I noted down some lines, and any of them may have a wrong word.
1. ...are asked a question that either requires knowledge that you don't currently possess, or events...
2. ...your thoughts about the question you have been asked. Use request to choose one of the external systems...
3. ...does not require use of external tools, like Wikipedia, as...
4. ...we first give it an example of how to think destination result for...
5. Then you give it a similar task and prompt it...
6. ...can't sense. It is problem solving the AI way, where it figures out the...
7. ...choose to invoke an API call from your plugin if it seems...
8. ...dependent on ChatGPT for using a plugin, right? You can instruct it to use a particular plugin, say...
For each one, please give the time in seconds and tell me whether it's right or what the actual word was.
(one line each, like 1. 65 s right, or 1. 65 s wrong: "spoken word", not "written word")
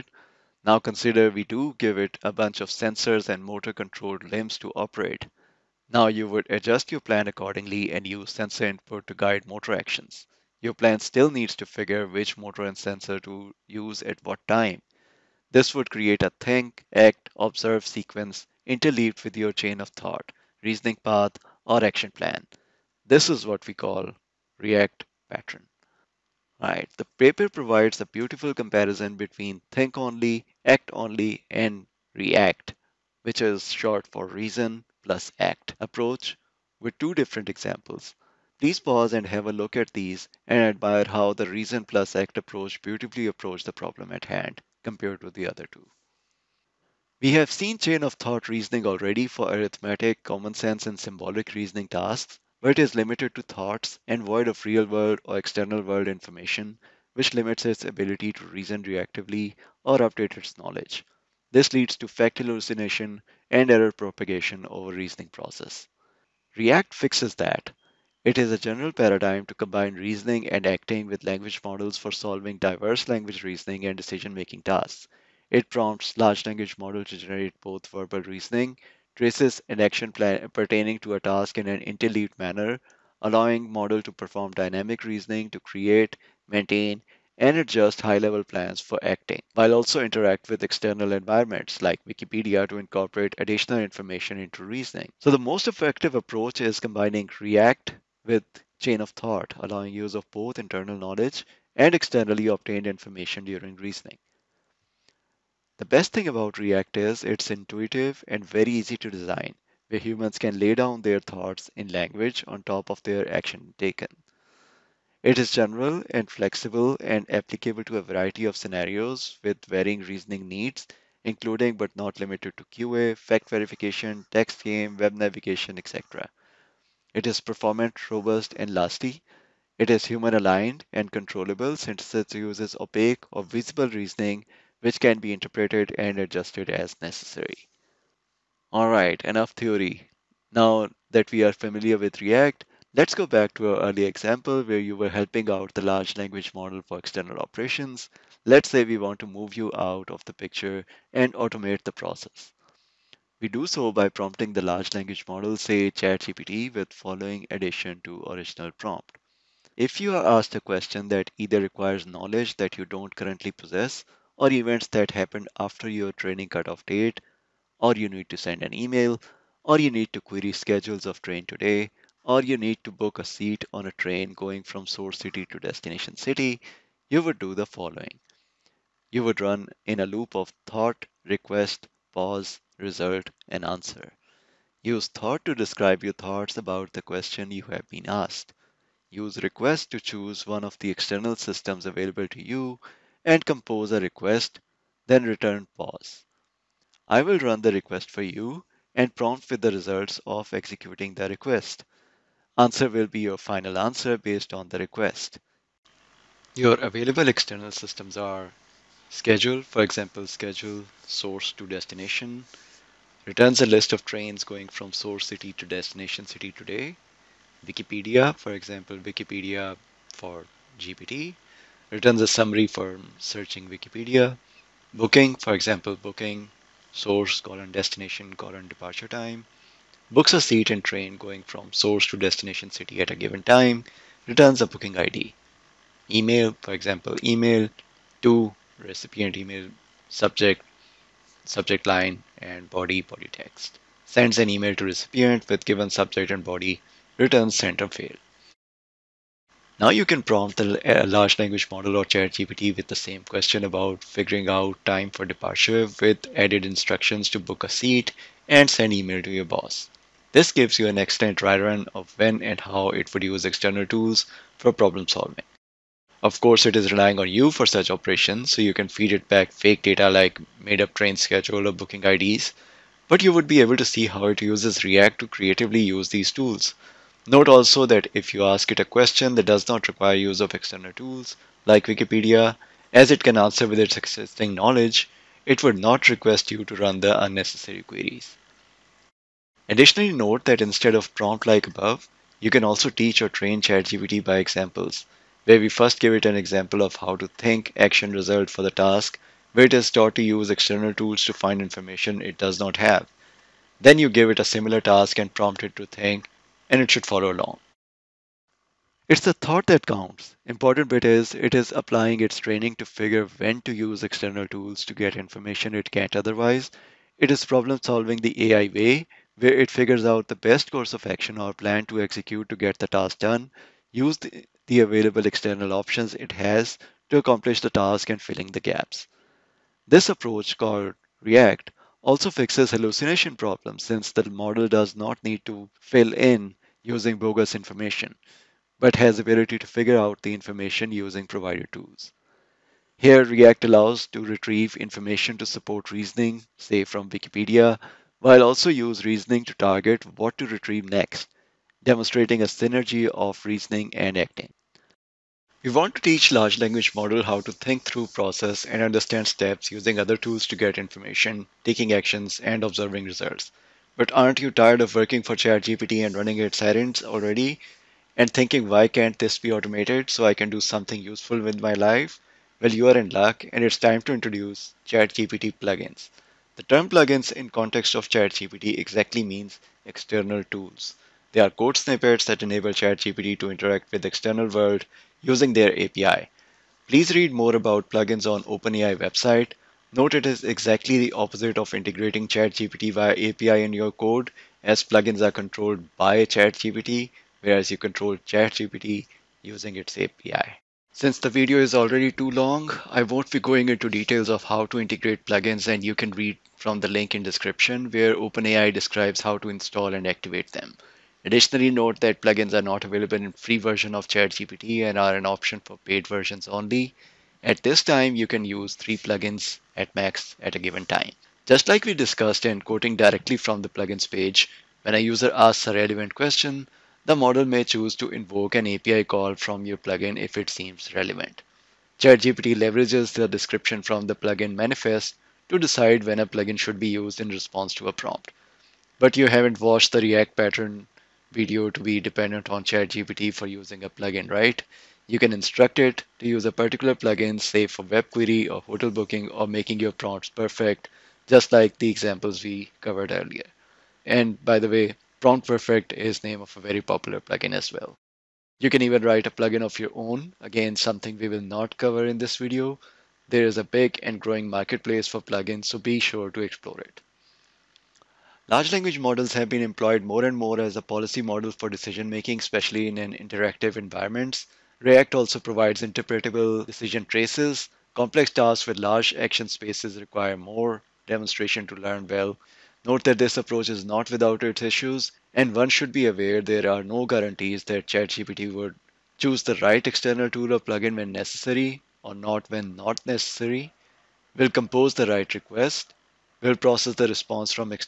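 1. 160 s right
2. 186 s right
3. 279 s right
4. 295 s wrong: "action", not "destination"
5. 303 s right
6. 315 s wrong: "otherwise", not "sense"
7. 427 s right
8. 441 s right.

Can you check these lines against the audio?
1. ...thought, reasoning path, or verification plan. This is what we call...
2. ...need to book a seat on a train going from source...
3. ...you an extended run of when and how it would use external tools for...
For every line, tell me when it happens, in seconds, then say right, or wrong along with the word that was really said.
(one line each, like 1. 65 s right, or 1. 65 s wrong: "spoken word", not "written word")
1. 19 s wrong: "action", not "verification"
2. 172 s right
3. 260 s right.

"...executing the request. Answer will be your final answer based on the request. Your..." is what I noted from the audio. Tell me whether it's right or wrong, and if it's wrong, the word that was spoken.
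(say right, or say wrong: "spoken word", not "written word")
right.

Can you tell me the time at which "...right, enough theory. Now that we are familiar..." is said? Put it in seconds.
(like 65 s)
138 s.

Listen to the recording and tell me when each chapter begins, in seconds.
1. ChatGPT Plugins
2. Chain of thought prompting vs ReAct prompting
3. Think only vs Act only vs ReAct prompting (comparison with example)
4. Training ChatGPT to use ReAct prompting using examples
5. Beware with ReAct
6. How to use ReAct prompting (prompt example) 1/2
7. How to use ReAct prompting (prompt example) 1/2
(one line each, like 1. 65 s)
1. 354 s
2. 46 s
3. 26 s
4. 308 s
5. 467 s
6. 137 s
7. 205 s.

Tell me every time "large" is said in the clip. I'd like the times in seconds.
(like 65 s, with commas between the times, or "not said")
76 s, 145 s, 154 s, 251 s, 356 s, 468 s, 478 s.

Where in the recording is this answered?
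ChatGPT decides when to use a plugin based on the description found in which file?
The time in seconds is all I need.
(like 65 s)
434 s.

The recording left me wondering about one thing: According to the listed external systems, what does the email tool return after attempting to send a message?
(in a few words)
sent or failed.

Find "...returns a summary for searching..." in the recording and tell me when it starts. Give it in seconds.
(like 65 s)
221 s.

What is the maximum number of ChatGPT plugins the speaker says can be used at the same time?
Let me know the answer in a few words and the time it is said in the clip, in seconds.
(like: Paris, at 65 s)
3, at 418 s.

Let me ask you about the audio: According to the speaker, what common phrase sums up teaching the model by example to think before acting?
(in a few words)
It's the thought that counts.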